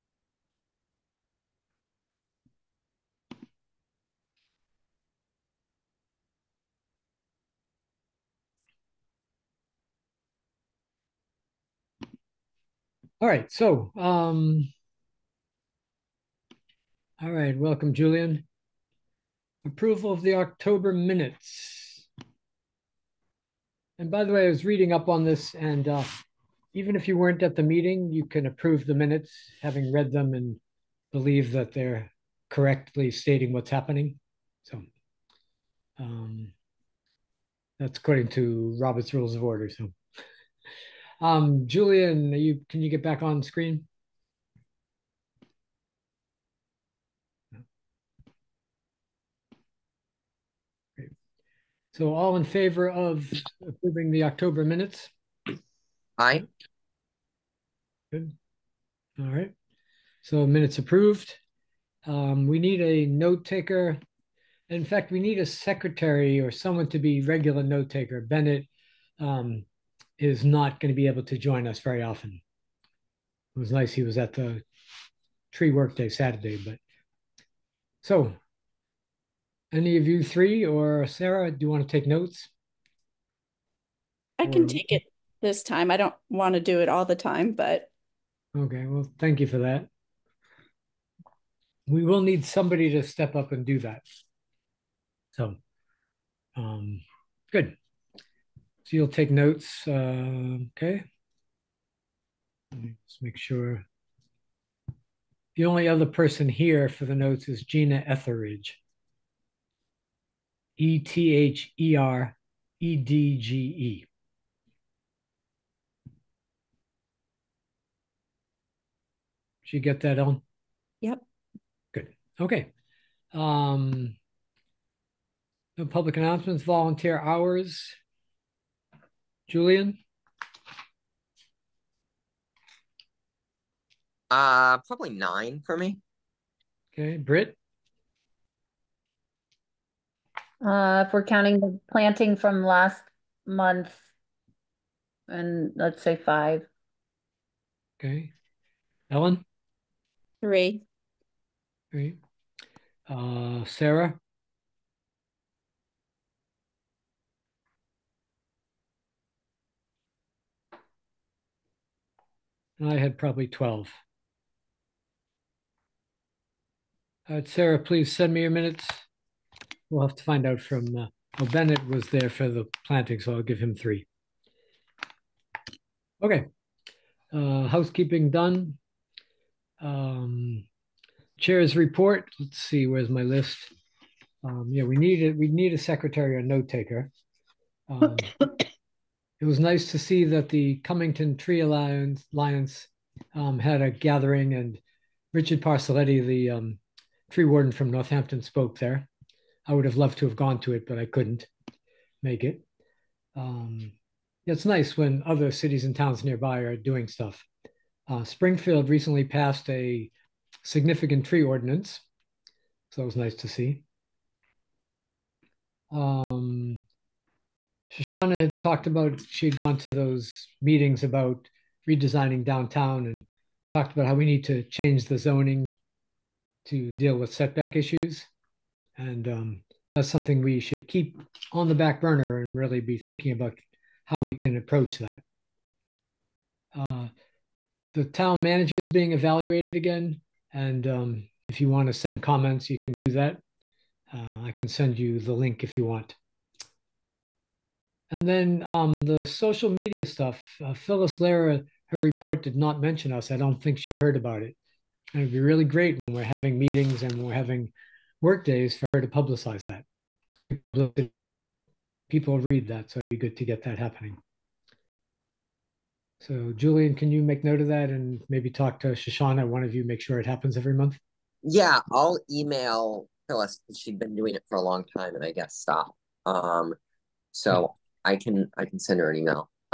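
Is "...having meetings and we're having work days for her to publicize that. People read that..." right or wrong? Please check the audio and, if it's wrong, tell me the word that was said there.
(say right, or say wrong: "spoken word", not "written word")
right.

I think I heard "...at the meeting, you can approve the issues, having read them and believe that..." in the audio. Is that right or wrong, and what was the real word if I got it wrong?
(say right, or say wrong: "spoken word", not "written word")
wrong: "minutes", not "issues".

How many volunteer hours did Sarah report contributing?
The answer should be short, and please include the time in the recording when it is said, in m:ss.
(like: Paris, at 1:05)
12, at 2:43.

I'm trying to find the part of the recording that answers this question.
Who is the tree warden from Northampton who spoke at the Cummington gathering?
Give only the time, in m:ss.
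3:15.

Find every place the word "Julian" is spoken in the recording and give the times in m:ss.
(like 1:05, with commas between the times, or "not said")
0:17, 0:41, 2:09, 4:26.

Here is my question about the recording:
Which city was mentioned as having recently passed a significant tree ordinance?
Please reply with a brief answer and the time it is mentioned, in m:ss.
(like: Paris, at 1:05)
Springfield, at 3:28.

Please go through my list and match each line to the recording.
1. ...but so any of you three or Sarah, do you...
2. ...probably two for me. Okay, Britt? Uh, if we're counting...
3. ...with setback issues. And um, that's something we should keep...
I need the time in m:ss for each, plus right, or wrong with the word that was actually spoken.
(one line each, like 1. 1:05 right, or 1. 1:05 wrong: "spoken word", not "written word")
1. 1:16 right
2. 2:14 wrong: "nine", not "two"
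3. 3:47 right.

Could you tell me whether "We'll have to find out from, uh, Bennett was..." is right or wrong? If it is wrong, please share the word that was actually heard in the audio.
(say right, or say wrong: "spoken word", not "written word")
right.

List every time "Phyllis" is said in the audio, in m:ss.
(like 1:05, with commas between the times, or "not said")
4:10, 4:33.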